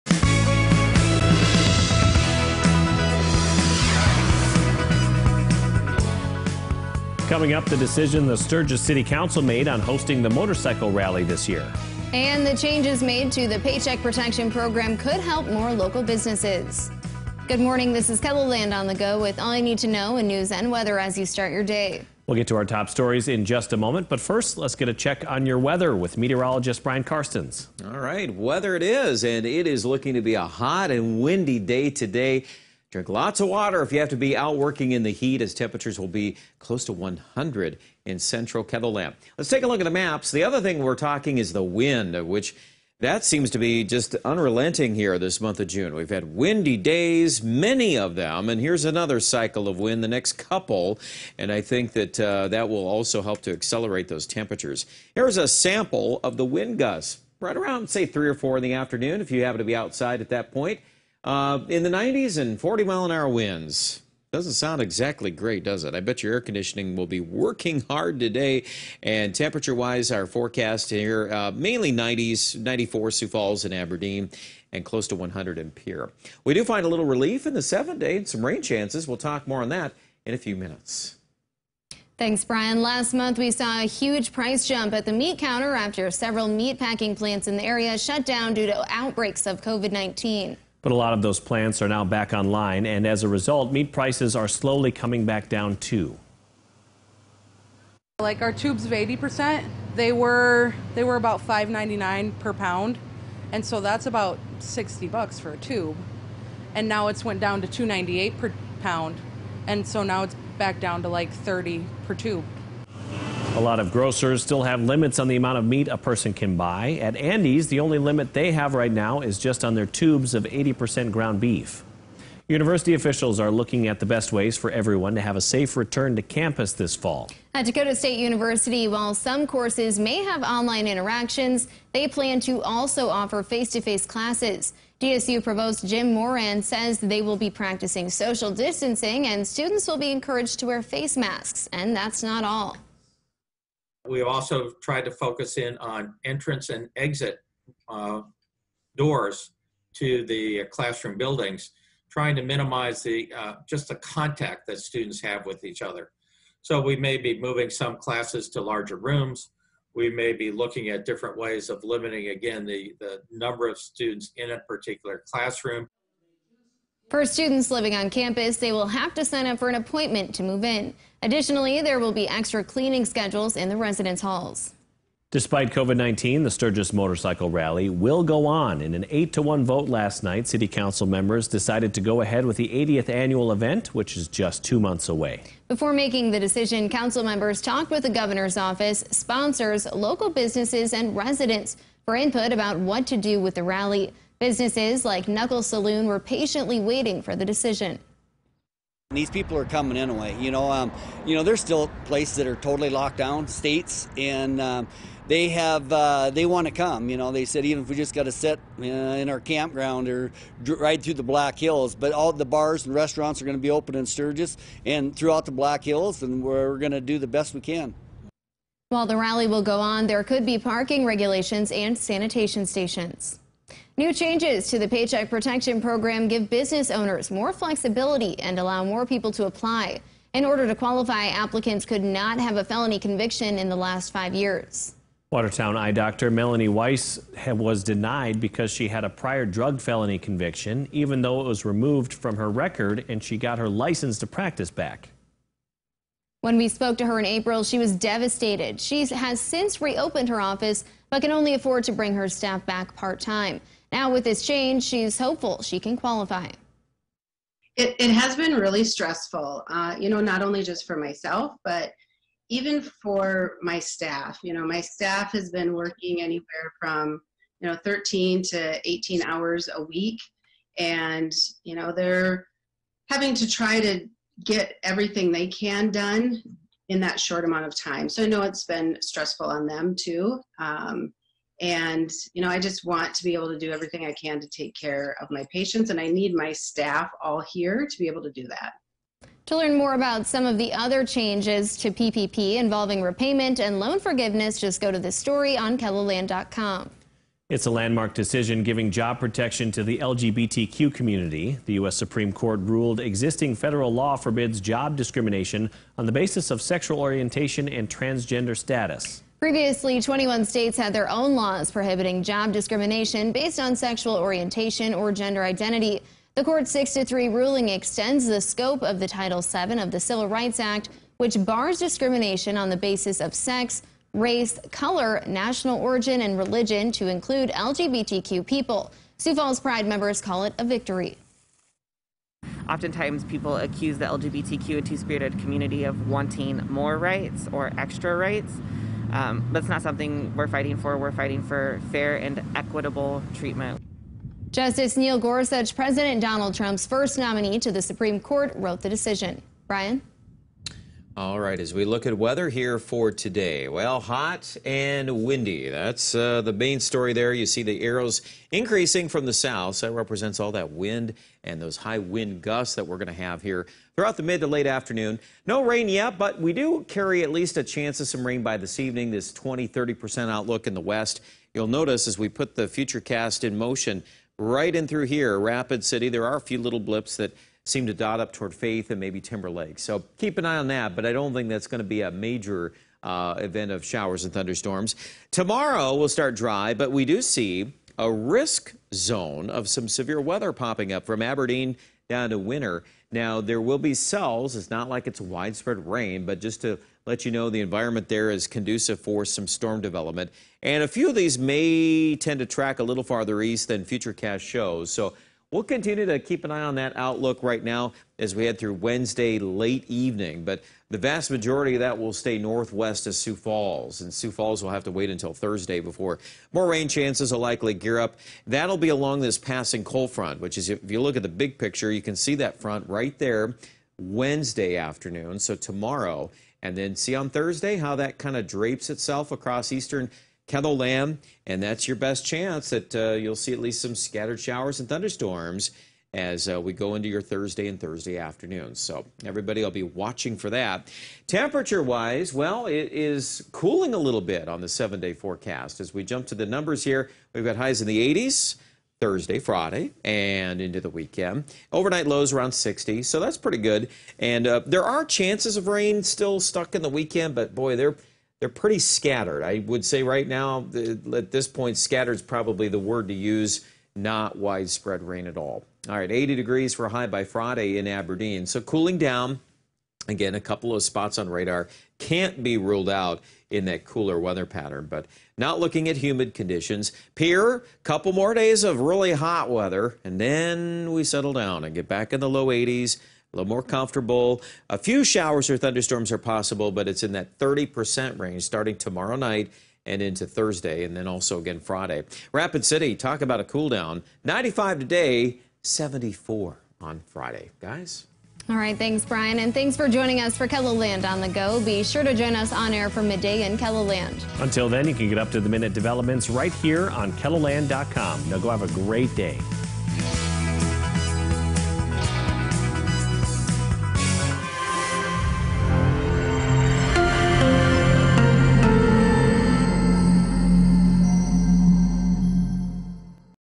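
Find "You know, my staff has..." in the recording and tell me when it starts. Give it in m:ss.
4:24.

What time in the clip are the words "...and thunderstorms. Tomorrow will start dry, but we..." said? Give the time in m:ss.
6:24.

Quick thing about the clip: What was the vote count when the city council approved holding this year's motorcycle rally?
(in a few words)
8 to 1.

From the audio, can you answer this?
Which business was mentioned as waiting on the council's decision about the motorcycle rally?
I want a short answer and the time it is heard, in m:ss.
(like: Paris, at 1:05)
Knuckle Saloon, at 3:15.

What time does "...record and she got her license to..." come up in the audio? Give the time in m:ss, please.
4:02.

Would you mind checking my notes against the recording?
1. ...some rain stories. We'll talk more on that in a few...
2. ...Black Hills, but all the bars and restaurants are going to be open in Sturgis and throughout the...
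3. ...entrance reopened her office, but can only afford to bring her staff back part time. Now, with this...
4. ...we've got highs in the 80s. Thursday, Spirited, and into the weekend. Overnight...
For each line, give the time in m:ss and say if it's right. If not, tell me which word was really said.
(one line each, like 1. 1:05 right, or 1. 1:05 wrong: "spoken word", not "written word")
1. 1:18 wrong: "chances", not "stories"
2. 3:31 right
3. 4:09 wrong: "since", not "entrance"
4. 7:27 wrong: "Friday", not "Spirited".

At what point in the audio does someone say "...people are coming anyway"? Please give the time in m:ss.
3:19.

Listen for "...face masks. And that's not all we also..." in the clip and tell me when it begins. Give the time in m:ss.
2:20.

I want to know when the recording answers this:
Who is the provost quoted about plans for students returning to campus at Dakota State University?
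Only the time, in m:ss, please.
2:15.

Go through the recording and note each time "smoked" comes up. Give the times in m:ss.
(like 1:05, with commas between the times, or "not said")
not said.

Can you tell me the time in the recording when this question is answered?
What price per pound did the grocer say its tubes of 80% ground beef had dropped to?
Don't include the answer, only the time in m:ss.
1:47.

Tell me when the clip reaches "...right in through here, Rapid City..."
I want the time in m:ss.
6:14.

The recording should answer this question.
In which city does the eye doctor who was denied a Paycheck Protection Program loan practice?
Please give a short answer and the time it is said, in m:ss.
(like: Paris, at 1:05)
Watertown, at 3:55.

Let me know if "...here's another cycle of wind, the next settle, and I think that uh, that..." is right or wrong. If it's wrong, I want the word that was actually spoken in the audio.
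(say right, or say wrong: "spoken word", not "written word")
wrong: "couple", not "settle".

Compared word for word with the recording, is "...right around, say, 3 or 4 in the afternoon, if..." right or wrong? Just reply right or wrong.
right.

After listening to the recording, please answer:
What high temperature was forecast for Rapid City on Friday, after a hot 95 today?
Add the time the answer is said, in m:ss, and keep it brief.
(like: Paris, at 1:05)
74, at 8:15.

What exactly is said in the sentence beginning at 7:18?
So everybody will be watching for that.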